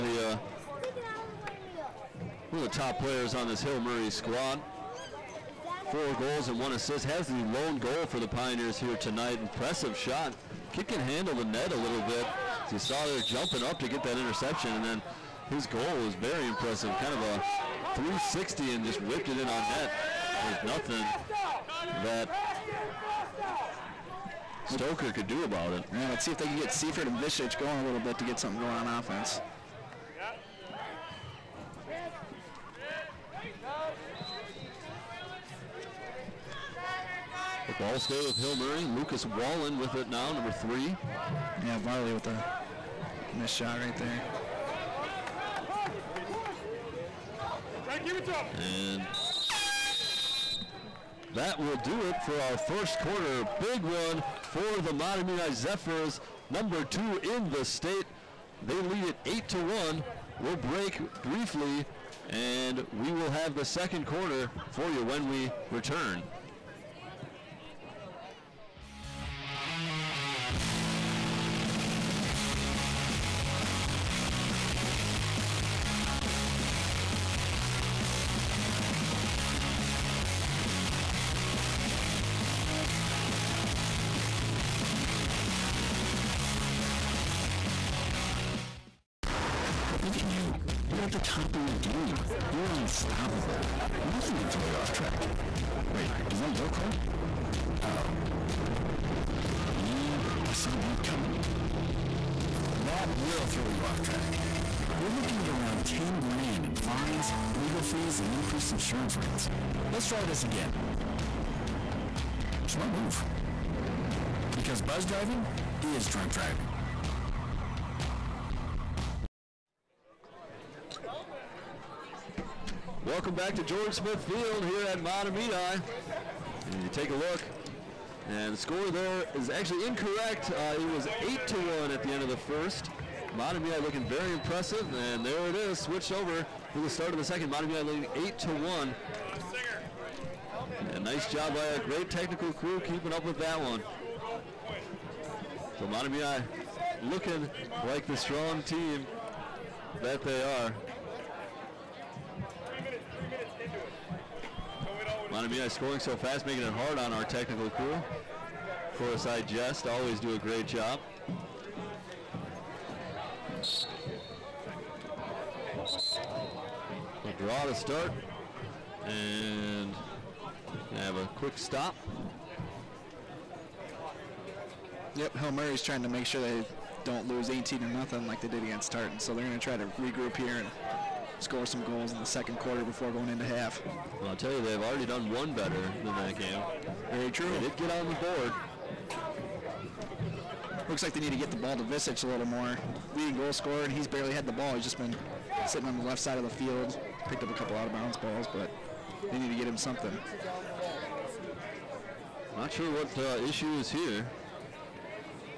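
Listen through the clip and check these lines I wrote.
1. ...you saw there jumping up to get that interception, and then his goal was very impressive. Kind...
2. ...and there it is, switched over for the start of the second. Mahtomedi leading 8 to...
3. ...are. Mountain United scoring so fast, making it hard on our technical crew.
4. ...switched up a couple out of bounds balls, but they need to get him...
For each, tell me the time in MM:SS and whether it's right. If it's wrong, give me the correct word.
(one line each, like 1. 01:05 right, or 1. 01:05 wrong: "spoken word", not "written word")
1. 00:12 right
2. 02:14 right
3. 02:30 right
4. 03:17 wrong: "picked", not "switched".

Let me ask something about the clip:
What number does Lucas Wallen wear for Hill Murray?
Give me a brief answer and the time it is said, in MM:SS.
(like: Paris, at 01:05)
3, at 00:40.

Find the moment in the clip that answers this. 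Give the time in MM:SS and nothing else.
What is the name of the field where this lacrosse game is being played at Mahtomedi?
02:03.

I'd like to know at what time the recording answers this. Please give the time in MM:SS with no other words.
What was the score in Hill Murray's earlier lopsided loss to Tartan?
02:57.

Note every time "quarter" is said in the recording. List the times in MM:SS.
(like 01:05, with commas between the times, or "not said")
00:52, 01:04, 03:02.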